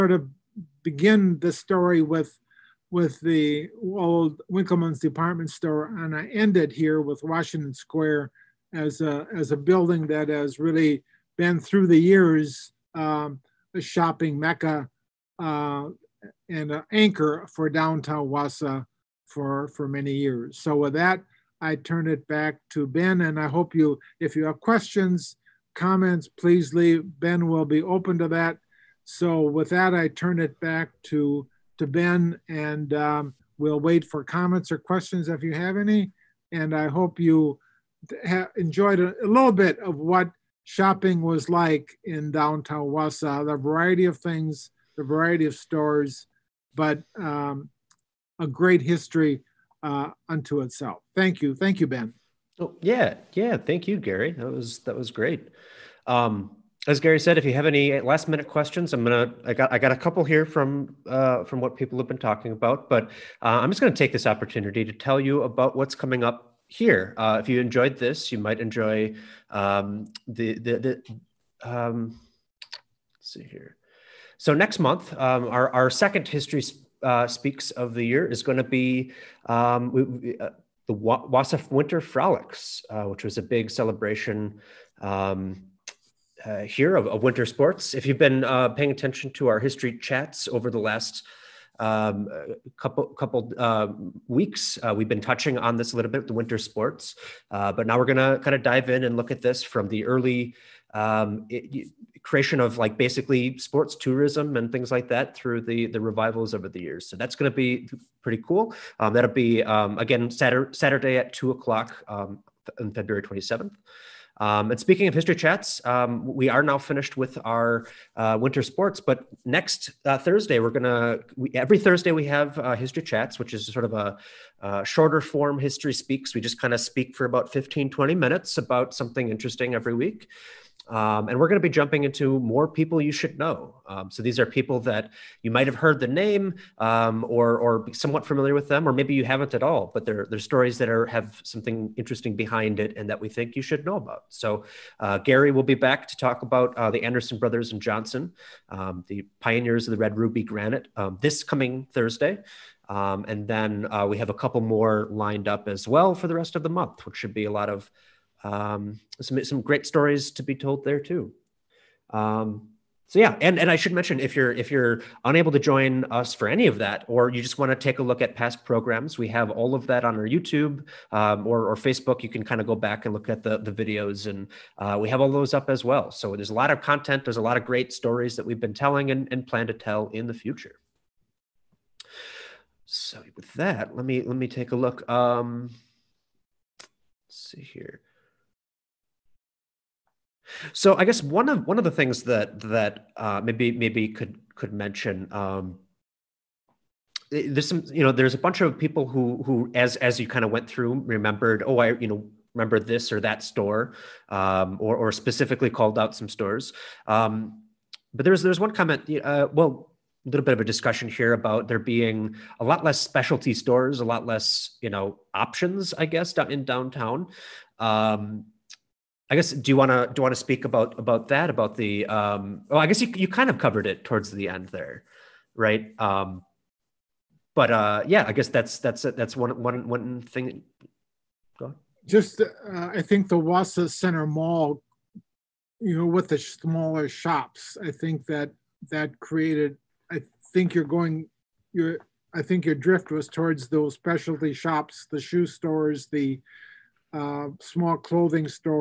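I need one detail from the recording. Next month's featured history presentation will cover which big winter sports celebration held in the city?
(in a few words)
Wausau Winter Frolics.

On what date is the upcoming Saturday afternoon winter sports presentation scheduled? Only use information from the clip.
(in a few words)
February 27.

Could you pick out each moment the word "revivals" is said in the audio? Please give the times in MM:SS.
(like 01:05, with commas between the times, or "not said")
01:45.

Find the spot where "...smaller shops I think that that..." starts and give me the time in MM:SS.
03:56.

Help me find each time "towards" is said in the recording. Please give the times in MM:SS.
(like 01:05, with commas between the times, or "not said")
03:44, 04:03.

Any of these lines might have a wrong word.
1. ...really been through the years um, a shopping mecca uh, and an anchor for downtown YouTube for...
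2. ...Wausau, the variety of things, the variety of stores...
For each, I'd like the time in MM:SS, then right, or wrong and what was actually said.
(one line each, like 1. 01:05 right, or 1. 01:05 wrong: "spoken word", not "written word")
1. 00:10 wrong: "Wausau", not "YouTube"
2. 00:42 right.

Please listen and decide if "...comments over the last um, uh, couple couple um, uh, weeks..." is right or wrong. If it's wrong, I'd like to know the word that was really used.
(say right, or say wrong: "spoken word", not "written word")
wrong: "chats", not "comments".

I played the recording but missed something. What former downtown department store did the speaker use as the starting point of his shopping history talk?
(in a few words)
Winkelman's.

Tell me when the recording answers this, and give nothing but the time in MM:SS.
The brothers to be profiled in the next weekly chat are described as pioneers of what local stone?
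02:29.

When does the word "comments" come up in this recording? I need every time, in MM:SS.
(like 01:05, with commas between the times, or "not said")
00:25, 00:34, 03:28.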